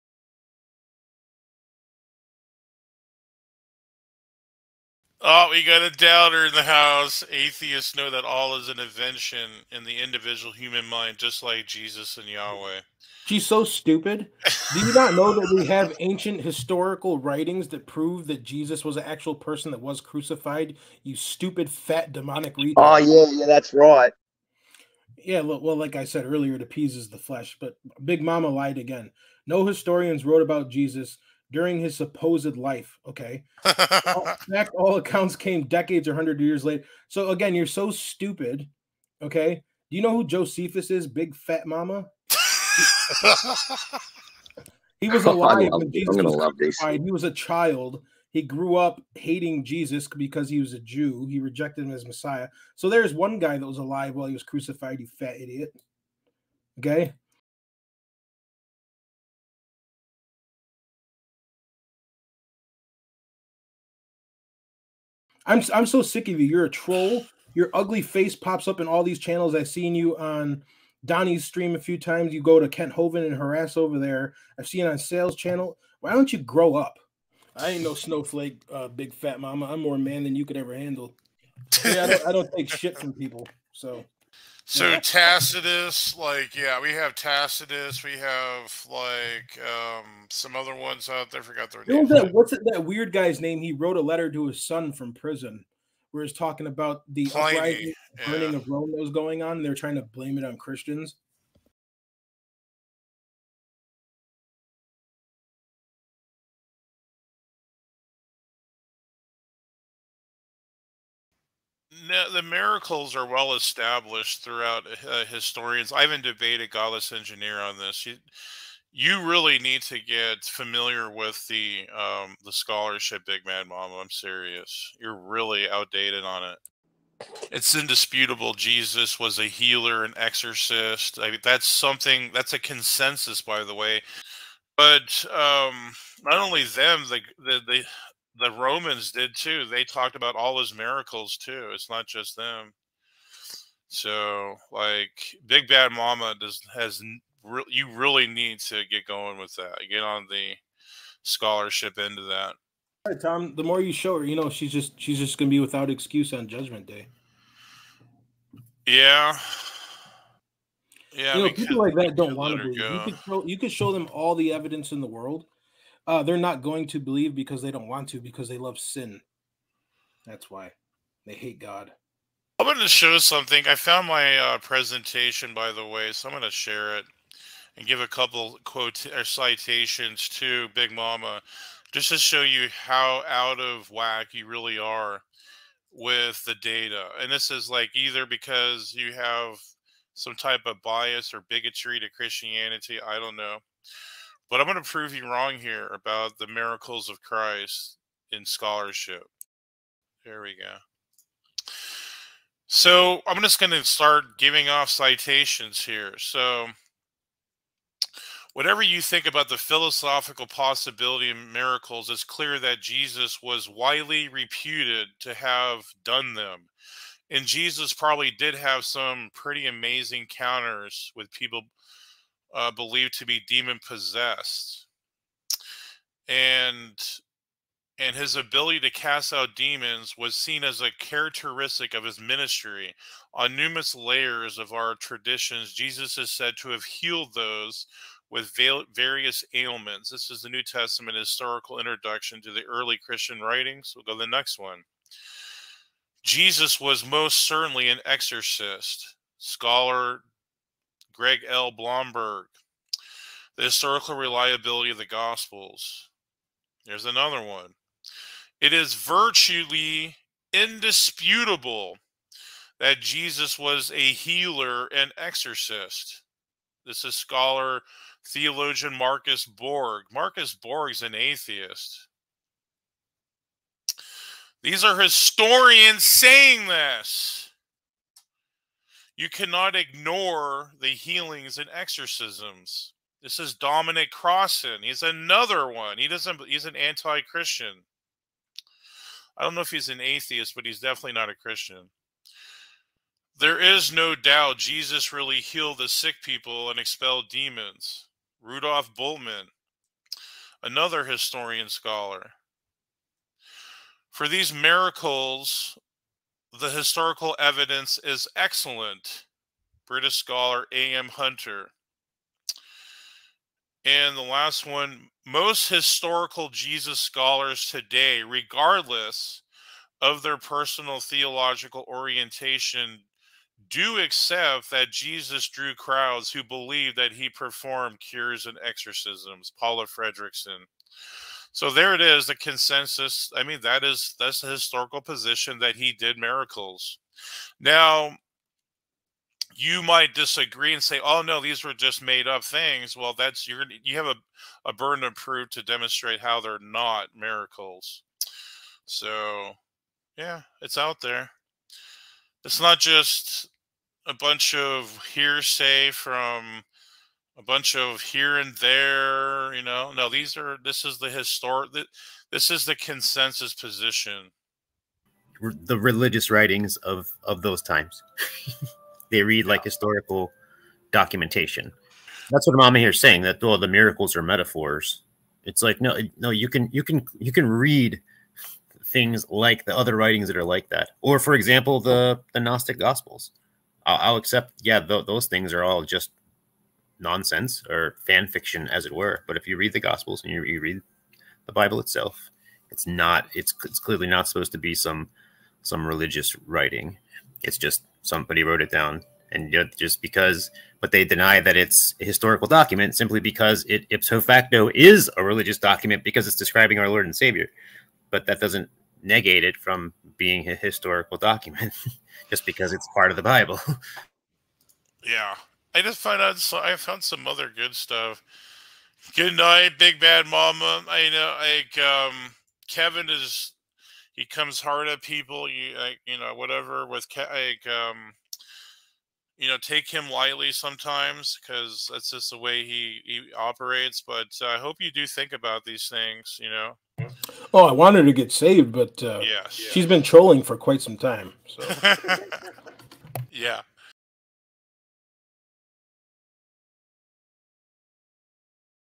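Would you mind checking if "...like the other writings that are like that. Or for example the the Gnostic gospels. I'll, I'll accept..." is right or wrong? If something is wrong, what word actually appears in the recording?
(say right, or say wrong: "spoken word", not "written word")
right.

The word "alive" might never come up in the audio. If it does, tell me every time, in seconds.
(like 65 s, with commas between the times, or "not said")
45 s, 53 s.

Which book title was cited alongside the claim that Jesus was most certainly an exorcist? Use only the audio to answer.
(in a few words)
The Historical Reliability of the Gospels.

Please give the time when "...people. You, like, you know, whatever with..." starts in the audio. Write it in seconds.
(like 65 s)
425 s.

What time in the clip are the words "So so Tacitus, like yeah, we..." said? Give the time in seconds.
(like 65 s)
83 s.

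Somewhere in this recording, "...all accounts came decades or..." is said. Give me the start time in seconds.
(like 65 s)
34 s.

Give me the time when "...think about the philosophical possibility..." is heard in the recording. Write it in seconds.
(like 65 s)
209 s.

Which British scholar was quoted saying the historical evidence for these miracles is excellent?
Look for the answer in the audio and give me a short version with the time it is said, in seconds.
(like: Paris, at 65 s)
A.M. Hunter, at 310 s.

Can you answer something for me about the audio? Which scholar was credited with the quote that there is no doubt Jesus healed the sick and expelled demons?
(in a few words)
Rudolf Bultmann.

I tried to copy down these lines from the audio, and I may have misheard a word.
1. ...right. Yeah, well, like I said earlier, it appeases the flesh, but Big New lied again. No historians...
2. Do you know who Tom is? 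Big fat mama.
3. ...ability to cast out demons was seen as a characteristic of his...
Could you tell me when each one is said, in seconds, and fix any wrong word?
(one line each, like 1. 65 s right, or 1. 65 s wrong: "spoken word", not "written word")
1. 23 s wrong: "Mama", not "New"
2. 39 s wrong: "Josephus", not "Tom"
3. 228 s right.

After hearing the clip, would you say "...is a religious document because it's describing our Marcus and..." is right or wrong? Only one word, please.
wrong.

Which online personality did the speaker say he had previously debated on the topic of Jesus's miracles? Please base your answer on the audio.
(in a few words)
Godless Engineer.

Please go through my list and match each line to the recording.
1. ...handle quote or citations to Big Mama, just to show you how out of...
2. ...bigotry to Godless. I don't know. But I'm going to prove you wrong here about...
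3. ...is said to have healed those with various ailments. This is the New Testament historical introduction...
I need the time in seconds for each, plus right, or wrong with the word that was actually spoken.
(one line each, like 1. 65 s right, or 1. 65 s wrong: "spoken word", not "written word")
1. 178 s wrong: "couple", not "handle"
2. 191 s wrong: "Christianity", not "Godless"
3. 236 s right.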